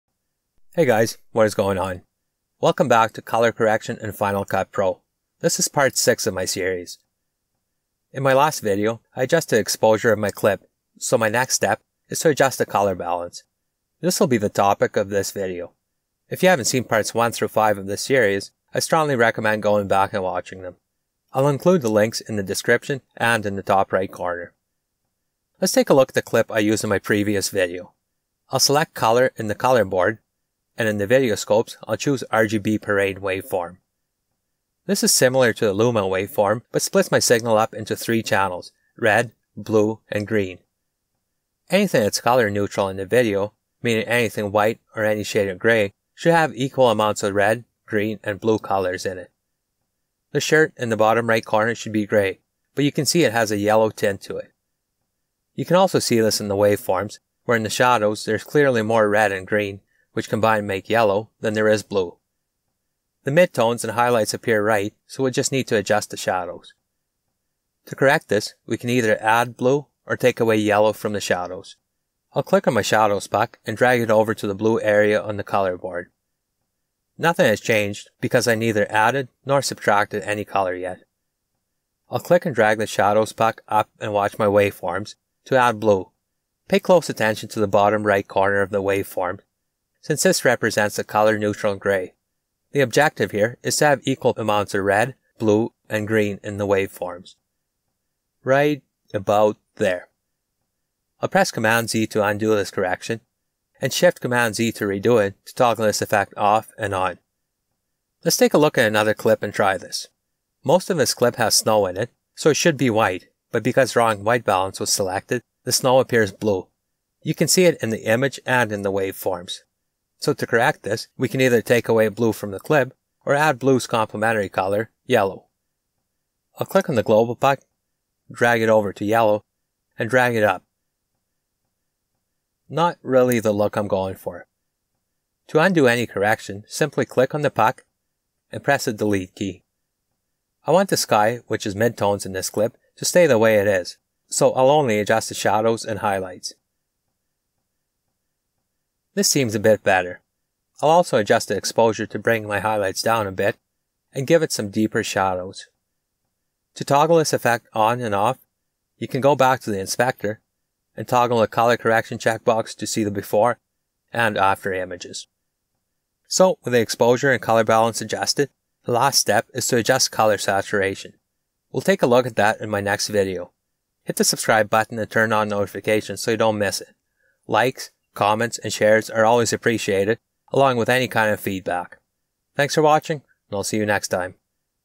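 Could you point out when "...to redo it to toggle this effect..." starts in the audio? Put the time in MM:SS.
01:44.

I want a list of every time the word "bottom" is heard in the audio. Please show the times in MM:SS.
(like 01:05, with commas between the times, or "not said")
00:50, 01:27.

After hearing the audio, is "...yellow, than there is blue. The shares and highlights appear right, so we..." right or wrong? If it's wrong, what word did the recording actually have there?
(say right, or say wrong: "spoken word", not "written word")
wrong: "midtones", not "shares".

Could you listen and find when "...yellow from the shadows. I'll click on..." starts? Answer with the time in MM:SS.
01:10.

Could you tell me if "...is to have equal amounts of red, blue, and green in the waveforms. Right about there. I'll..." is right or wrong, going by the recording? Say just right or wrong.
right.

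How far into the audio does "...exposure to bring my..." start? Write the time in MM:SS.
02:31.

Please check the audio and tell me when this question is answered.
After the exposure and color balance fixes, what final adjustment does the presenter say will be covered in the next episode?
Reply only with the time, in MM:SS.
02:50.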